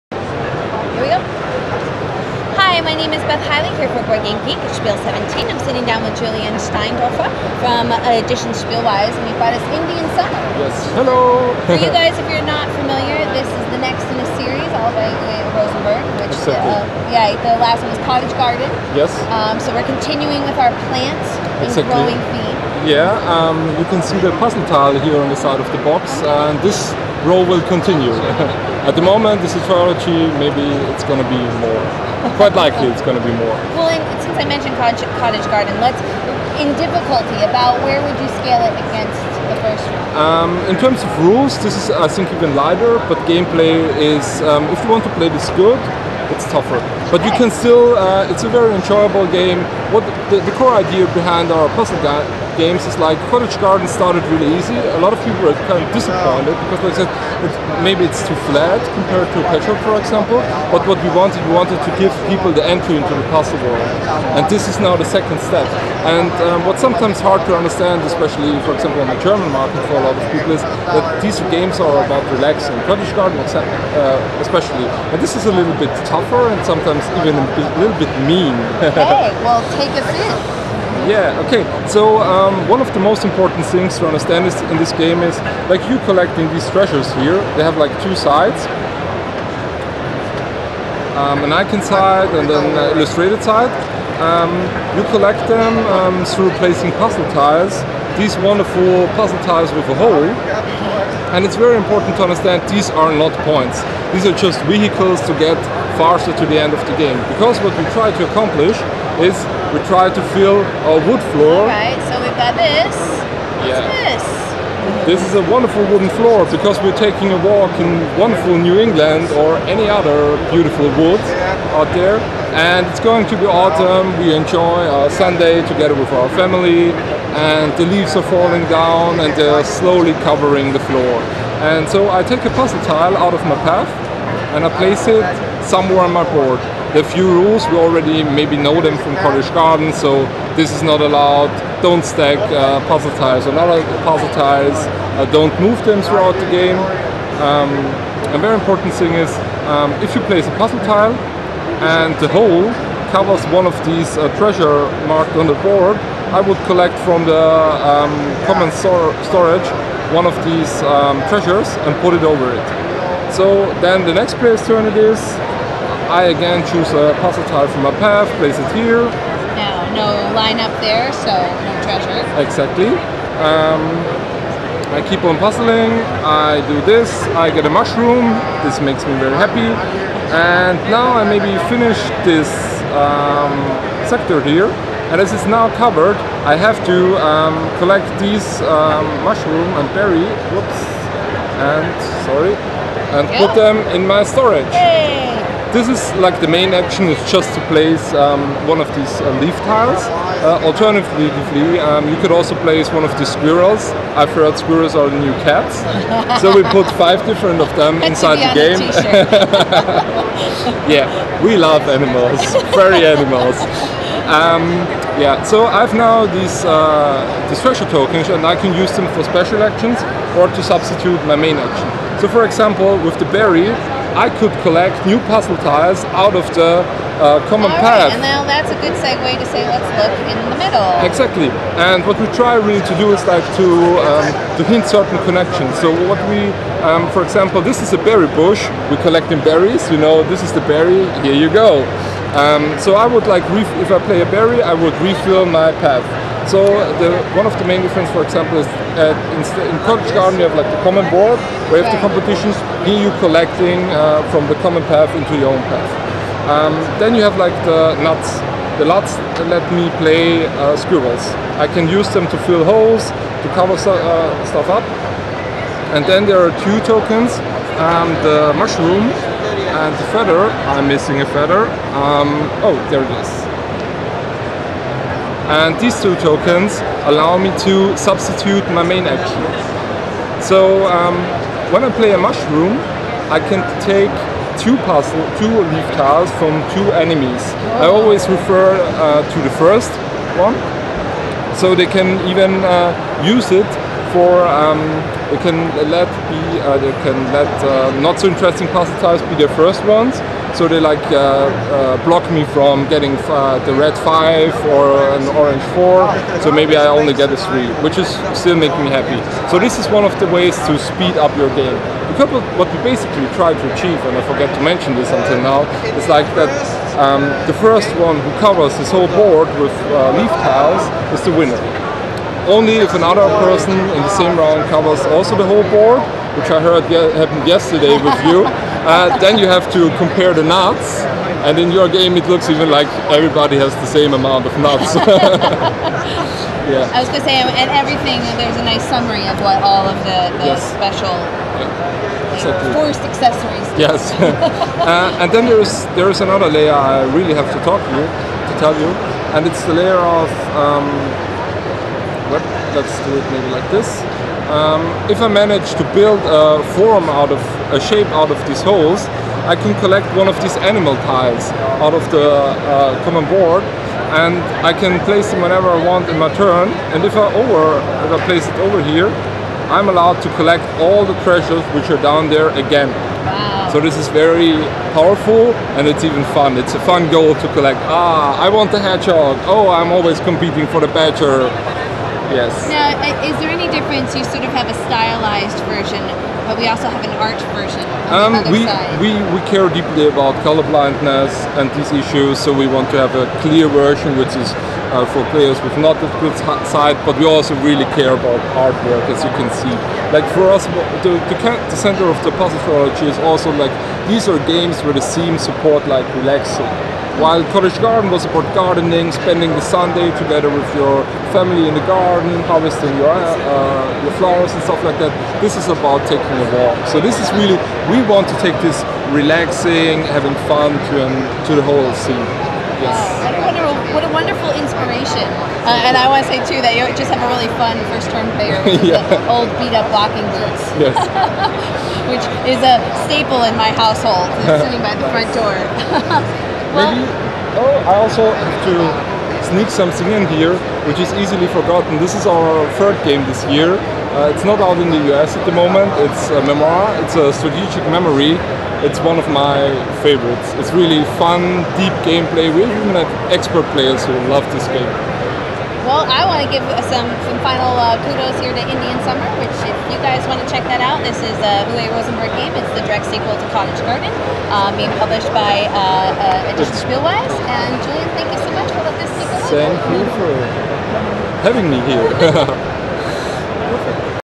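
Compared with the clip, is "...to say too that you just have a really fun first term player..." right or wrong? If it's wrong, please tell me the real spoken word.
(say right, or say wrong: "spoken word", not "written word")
right.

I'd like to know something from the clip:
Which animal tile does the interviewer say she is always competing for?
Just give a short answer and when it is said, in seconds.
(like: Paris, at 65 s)
badger, at 380 s.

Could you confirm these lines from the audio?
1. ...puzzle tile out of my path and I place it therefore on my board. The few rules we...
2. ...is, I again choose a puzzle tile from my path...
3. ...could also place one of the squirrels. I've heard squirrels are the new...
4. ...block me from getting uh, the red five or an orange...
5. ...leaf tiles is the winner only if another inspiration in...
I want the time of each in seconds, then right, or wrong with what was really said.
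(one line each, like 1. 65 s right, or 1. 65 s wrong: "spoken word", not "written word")
1. 132 s wrong: "somewhere", not "therefore"
2. 164 s right
3. 202 s right
4. 302 s right
5. 320 s wrong: "person", not "inspiration".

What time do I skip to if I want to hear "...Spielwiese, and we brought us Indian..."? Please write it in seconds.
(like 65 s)
8 s.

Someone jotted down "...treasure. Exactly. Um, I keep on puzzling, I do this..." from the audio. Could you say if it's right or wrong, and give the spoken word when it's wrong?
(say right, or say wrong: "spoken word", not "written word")
right.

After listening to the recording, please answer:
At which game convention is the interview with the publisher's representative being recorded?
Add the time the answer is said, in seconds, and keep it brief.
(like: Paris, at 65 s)
Spiel 17, at 4 s.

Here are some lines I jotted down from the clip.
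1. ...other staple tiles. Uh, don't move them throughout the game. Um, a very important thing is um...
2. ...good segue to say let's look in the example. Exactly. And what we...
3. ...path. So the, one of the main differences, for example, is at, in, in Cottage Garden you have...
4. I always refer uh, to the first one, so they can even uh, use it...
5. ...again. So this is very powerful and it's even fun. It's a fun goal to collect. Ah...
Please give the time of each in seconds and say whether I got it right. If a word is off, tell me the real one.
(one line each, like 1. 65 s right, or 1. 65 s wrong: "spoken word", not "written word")
1. 143 s wrong: "puzzle", not "staple"
2. 228 s wrong: "middle", not "example"
3. 245 s right
4. 287 s right
5. 372 s right.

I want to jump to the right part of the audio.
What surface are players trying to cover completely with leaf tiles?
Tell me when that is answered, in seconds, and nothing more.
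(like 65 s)
111 s.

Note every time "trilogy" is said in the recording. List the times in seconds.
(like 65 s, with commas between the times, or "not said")
29 s, 402 s.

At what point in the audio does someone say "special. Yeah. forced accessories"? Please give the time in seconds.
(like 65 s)
340 s.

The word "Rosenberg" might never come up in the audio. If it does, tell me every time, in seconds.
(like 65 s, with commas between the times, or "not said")
15 s, 461 s.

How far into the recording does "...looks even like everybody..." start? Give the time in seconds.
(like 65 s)
332 s.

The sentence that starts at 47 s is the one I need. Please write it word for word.
But you can still, uh, it's a very enjoyable game.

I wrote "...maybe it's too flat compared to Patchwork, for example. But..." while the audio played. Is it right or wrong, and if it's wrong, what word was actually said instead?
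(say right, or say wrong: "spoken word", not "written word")
right.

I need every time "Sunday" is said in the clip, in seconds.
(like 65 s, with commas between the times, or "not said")
125 s, 409 s.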